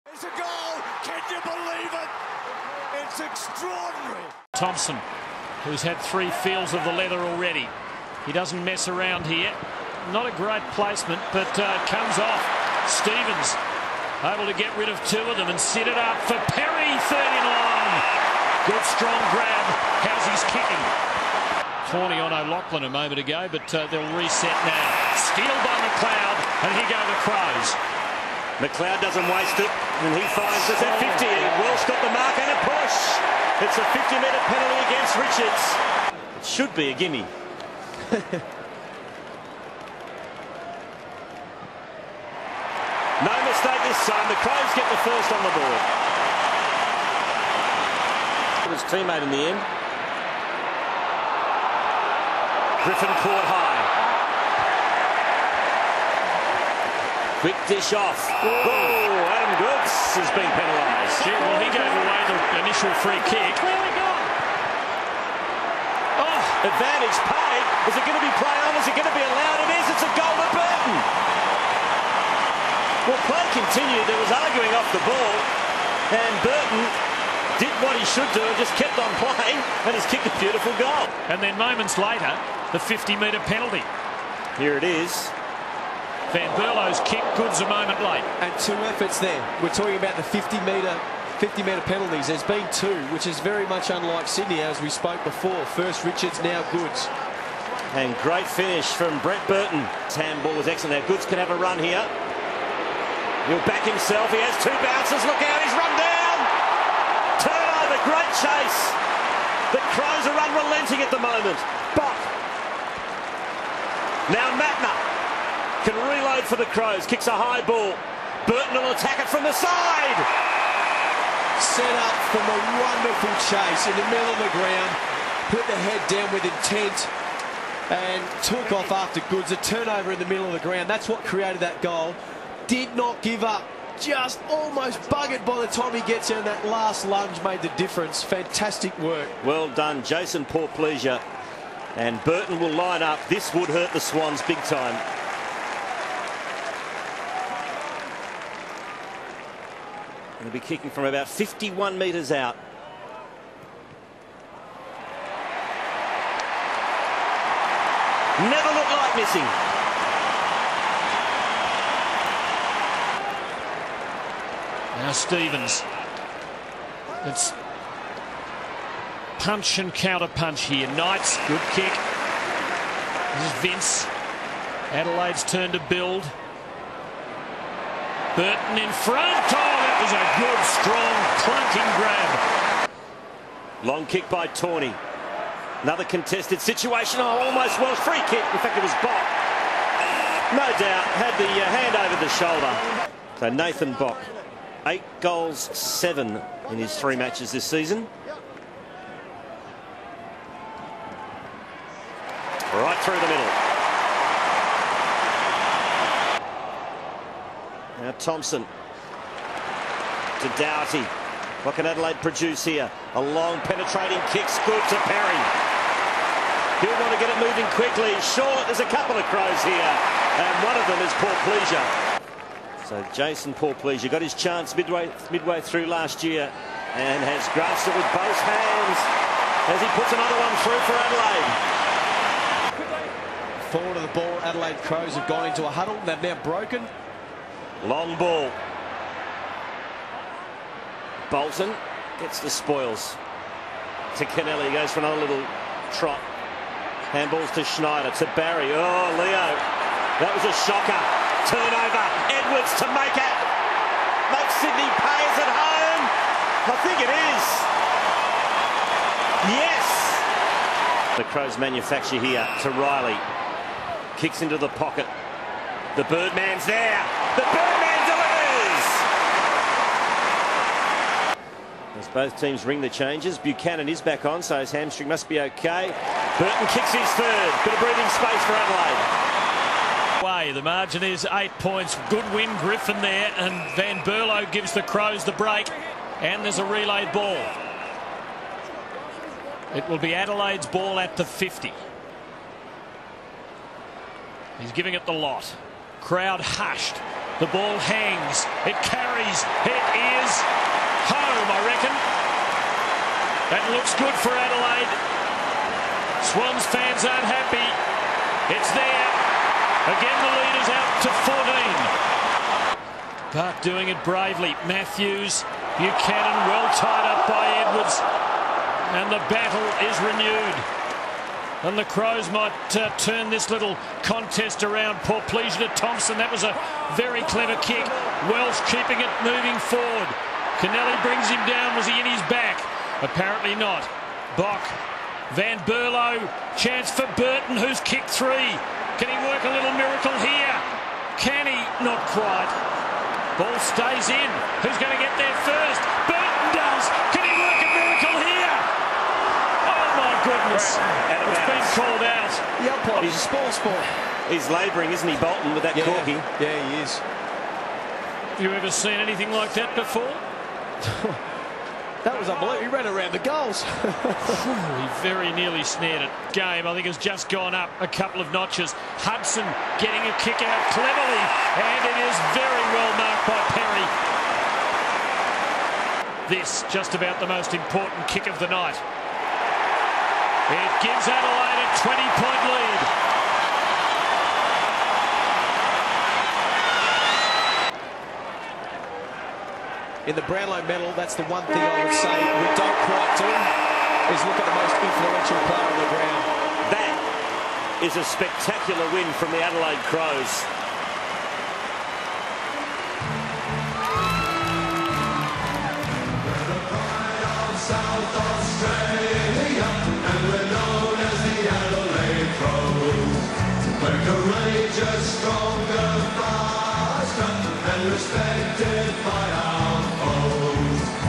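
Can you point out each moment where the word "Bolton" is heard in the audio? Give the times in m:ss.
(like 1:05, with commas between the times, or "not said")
4:01, 5:55.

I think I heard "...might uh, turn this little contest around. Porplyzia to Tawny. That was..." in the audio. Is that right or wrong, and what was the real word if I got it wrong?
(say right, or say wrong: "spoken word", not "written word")
wrong: "Thompson", not "Tawny".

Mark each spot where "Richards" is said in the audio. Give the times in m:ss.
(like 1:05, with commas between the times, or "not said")
0:35, 1:36.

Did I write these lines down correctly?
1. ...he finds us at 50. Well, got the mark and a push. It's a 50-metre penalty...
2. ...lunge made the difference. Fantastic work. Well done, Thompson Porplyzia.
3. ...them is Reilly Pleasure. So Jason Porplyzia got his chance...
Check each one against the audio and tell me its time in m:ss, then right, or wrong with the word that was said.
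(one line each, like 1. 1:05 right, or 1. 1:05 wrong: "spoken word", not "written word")
1. 0:30 right
2. 2:17 wrong: "Jason", not "Thompson"
3. 3:40 wrong: "Paul", not "Reilly".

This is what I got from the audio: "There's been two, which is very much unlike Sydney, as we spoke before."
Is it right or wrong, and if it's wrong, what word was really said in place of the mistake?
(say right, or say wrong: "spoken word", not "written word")
right.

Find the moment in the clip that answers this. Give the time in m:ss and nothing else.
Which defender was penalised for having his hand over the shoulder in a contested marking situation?
3:13.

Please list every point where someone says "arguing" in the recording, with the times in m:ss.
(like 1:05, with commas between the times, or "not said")
1:14.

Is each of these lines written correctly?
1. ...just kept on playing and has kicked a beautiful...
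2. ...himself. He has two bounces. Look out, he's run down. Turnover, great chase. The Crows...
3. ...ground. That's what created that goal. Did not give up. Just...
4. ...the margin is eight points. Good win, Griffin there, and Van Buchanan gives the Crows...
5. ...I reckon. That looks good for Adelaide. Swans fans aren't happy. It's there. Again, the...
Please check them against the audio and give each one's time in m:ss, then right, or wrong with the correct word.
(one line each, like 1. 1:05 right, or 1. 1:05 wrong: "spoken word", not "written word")
1. 1:18 right
2. 1:43 right
3. 2:10 right
4. 4:40 wrong: "Berlo", not "Buchanan"
5. 5:01 right.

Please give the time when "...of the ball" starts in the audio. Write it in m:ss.
3:53.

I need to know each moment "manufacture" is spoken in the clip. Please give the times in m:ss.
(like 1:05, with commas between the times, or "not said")
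4:21.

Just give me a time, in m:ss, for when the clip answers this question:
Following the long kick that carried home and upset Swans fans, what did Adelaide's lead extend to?
5:13.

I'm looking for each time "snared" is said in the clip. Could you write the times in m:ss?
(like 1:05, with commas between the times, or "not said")
6:05.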